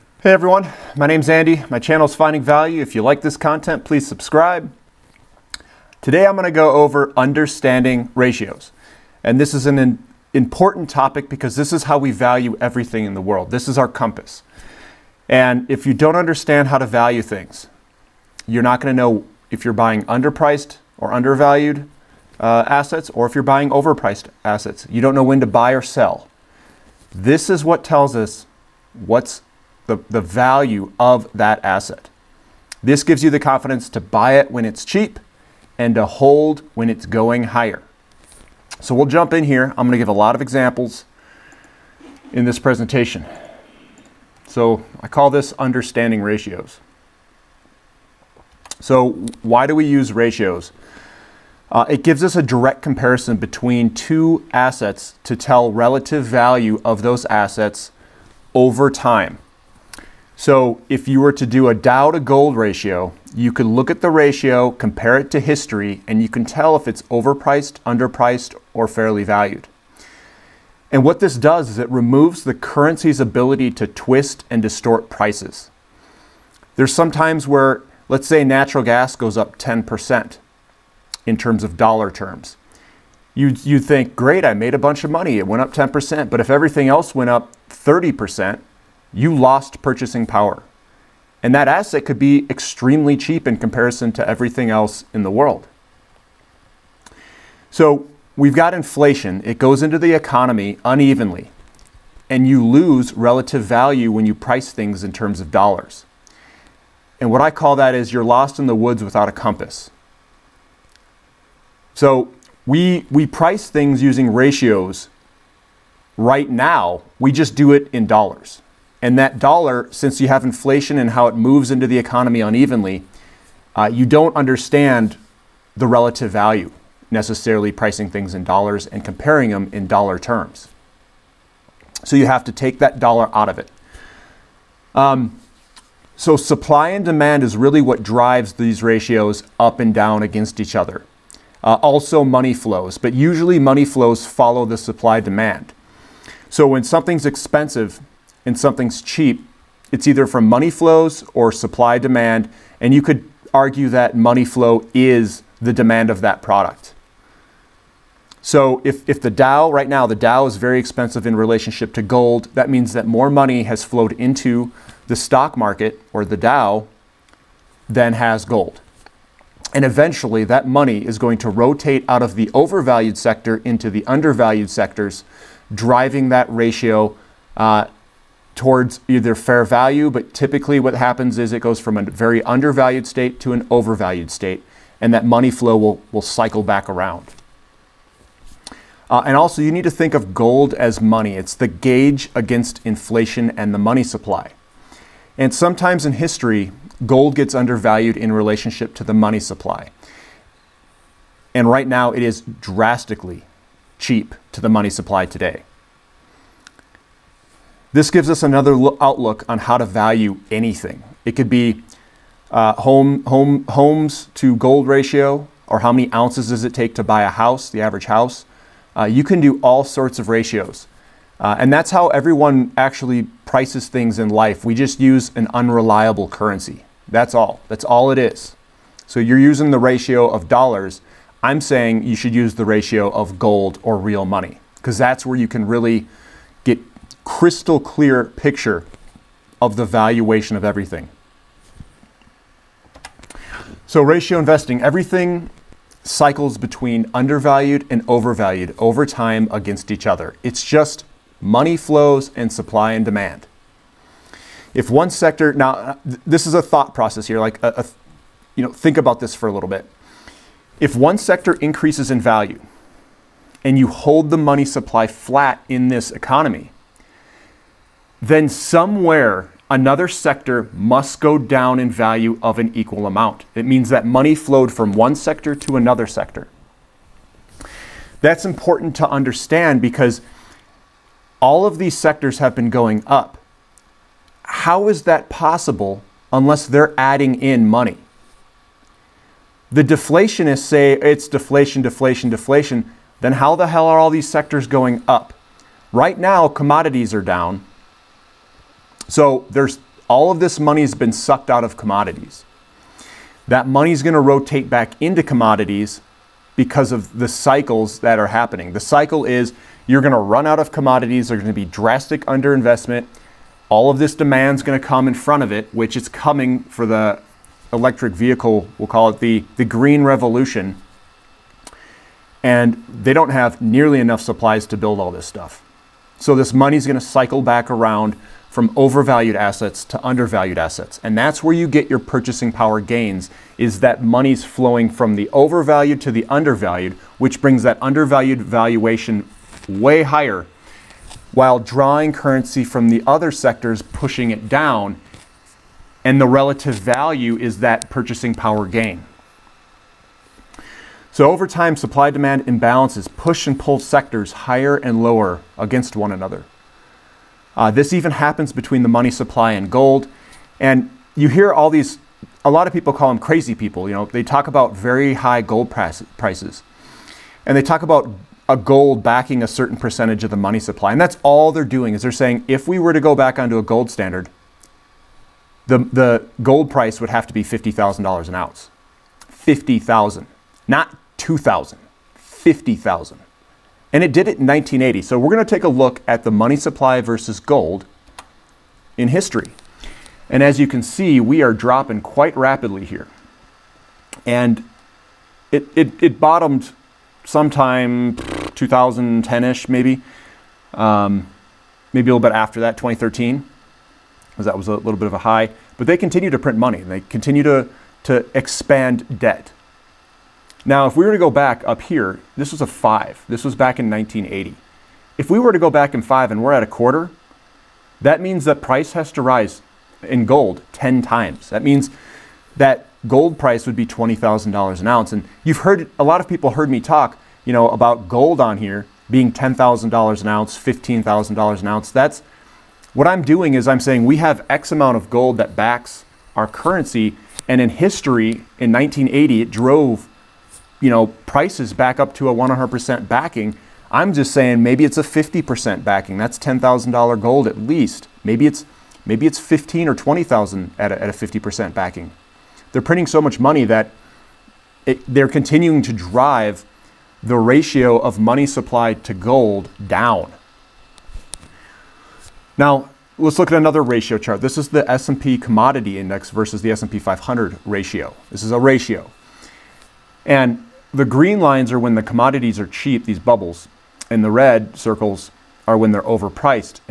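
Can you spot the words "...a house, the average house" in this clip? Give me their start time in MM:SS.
03:37.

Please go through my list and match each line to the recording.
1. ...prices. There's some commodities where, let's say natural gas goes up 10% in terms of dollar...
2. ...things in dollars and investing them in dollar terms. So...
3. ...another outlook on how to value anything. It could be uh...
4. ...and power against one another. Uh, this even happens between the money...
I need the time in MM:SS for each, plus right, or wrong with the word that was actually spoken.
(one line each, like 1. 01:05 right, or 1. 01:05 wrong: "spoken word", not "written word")
1. 01:15 wrong: "times", not "commodities"
2. 02:08 wrong: "comparing", not "investing"
3. 03:28 right
4. 05:54 wrong: "lower", not "power".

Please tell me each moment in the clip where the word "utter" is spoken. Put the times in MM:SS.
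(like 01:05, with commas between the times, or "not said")
not said.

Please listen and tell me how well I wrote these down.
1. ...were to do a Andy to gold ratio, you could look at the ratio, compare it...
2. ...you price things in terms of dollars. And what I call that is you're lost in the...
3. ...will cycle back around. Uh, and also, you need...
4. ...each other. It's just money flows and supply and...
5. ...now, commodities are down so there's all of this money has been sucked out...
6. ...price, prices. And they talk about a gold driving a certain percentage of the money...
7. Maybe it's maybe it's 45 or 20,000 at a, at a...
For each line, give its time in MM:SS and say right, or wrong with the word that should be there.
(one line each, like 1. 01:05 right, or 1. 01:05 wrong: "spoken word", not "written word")
1. 01:01 wrong: "Dow", not "Andy"
2. 01:44 right
3. 03:06 right
4. 04:09 right
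5. 04:56 right
6. 06:05 wrong: "backing", not "driving"
7. 07:28 wrong: "15", not "45".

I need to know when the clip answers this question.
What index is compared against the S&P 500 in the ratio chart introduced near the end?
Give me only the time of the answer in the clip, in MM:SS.
07:44.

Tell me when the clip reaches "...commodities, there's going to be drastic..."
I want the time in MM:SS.
05:10.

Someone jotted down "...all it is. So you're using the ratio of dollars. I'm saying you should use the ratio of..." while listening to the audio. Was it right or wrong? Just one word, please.
right.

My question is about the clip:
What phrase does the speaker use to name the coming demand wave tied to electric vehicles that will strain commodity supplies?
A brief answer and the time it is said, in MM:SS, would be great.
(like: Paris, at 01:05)
the green revolution, at 05:19.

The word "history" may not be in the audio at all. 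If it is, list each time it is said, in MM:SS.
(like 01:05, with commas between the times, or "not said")
01:05, 03:16, 06:29, 07:17.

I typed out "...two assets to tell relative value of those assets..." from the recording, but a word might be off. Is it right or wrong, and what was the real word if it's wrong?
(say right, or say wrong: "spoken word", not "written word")
right.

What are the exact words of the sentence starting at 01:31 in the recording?
And that asset could be extremely cheap in comparison to everything else in the world.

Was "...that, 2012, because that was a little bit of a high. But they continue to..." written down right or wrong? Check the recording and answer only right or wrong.
wrong.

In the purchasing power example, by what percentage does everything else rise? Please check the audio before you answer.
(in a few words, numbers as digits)
30%.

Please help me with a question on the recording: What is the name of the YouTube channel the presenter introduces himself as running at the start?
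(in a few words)
Finding Value.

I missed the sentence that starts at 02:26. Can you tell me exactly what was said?
So when something's expensive, and something's cheap, it's either from money flows or supply demand.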